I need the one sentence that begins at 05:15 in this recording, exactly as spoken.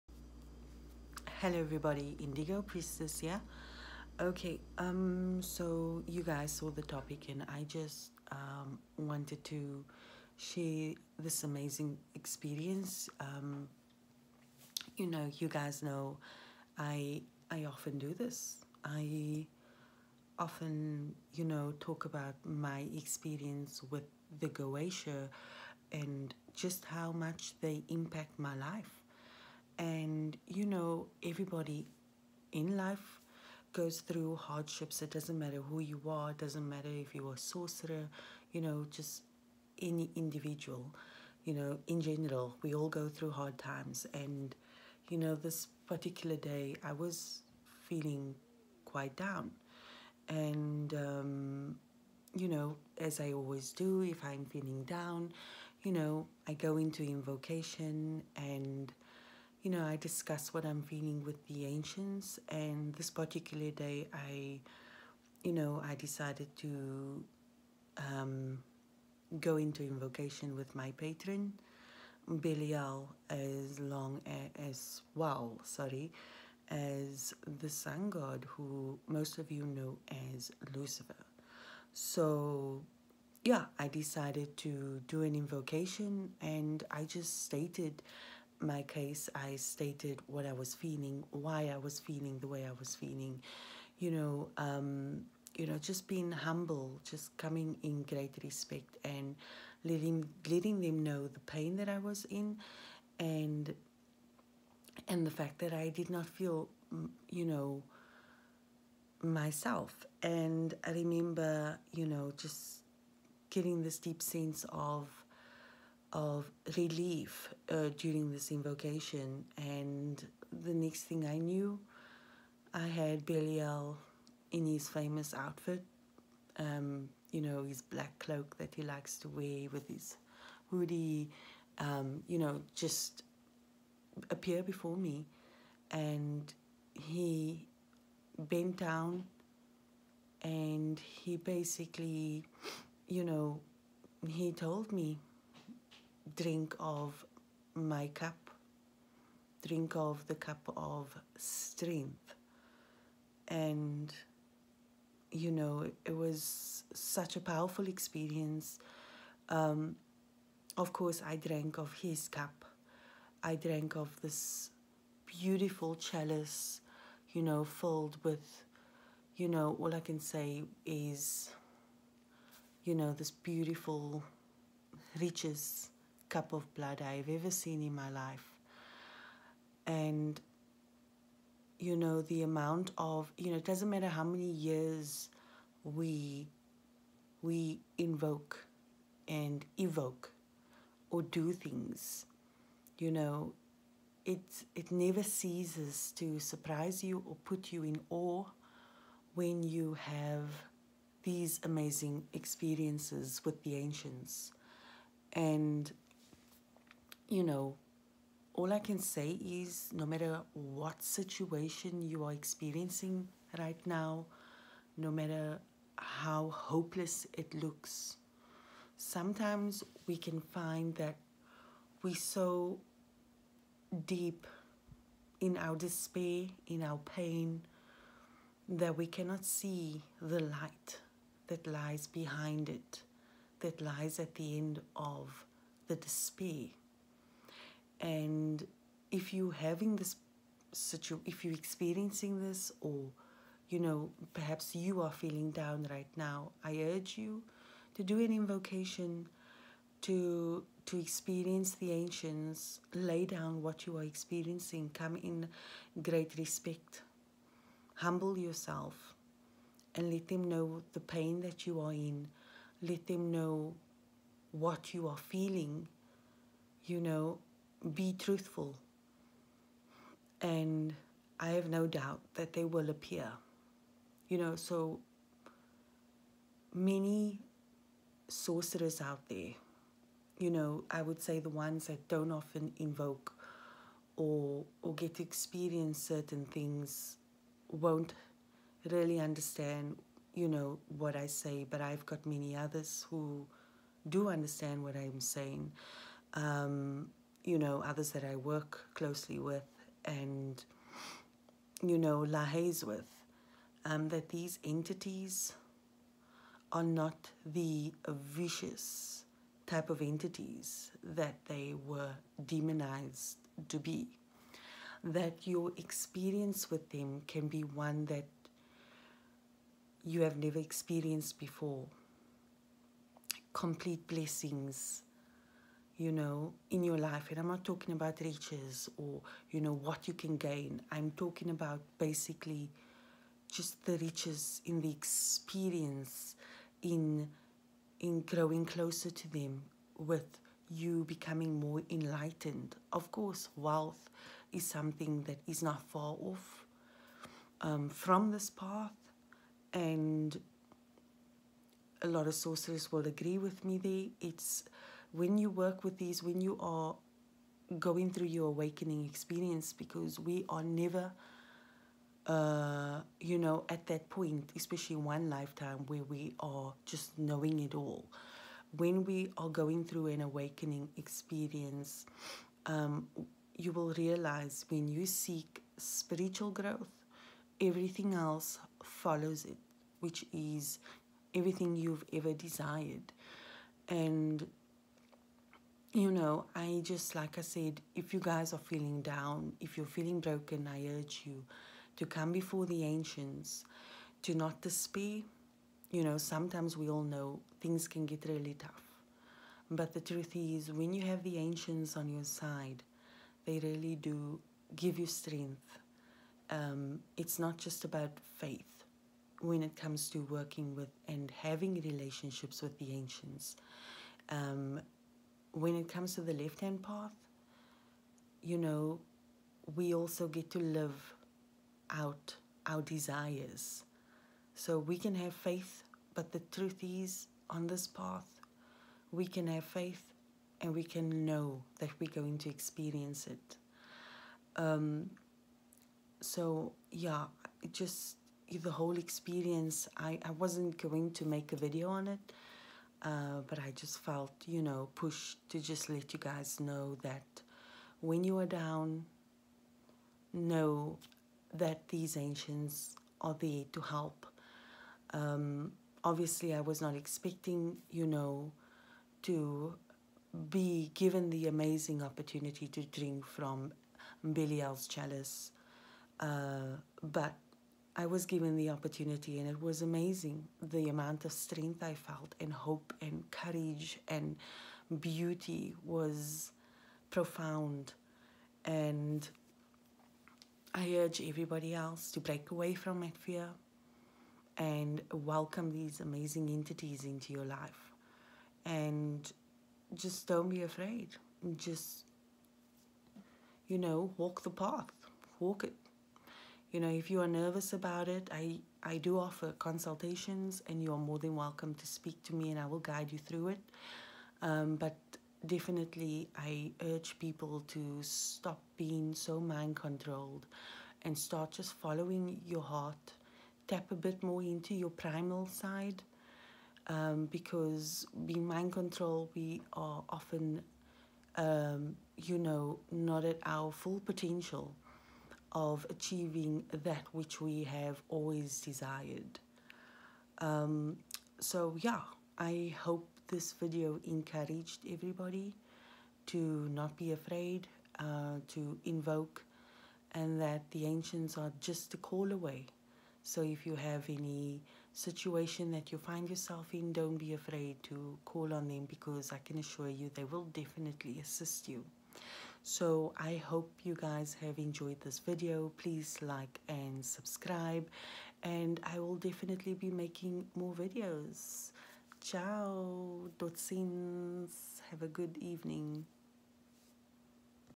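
That your experience with them can be one that you have never experienced before.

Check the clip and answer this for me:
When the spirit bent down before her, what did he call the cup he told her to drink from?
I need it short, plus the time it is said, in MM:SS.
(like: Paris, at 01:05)
The cup of strength, at 02:30.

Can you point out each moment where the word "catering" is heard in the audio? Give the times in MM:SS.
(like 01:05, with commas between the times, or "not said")
not said.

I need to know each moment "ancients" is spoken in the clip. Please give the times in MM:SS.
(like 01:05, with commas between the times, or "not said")
01:01, 03:23, 04:11, 06:32, 06:41, 06:52, 07:32, 09:00.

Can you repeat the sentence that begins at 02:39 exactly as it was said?
Um, of course, I drank of his cup.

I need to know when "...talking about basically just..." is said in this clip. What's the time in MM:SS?
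05:31.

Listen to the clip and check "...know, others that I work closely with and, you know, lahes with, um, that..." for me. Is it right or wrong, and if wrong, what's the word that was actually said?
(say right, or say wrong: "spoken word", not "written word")
right.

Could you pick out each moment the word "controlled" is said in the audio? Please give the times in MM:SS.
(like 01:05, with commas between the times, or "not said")
08:29, 08:38.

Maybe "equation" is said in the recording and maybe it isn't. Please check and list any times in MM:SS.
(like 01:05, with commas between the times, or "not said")
not said.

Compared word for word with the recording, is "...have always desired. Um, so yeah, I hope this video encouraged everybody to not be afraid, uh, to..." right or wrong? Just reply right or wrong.
right.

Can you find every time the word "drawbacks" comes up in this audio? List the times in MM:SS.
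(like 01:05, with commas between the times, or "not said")
not said.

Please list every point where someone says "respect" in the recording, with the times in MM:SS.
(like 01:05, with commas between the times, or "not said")
01:38, 04:16.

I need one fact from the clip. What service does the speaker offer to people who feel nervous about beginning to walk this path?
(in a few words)
Consultations.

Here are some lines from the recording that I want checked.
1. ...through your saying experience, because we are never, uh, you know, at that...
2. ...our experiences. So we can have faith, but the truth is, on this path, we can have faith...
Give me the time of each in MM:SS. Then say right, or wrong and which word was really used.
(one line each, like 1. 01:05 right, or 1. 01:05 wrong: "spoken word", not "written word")
1. 05:58 wrong: "awakening", not "saying"
2. 07:02 wrong: "desires", not "experiences".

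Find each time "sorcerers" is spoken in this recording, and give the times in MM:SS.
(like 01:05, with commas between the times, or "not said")
00:37, 04:38, 05:52.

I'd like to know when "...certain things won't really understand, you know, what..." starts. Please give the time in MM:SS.
04:45.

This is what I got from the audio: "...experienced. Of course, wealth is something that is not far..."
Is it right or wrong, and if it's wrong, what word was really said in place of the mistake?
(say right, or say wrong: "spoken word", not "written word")
wrong: "enlightened", not "experienced".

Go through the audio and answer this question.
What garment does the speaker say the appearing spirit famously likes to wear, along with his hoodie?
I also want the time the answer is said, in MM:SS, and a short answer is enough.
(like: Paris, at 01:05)
Black cloak, at 02:07.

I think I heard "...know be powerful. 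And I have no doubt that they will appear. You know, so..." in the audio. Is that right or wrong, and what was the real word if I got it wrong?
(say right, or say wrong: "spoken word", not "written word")
wrong: "truthful", not "powerful".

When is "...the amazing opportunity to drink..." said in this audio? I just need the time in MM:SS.
07:41.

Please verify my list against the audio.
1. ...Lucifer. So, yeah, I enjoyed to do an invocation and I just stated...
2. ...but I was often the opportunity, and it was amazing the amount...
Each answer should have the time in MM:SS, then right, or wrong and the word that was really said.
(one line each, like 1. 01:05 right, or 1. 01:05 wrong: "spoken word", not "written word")
1. 01:20 wrong: "decided", not "enjoyed"
2. 07:47 wrong: "given", not "often".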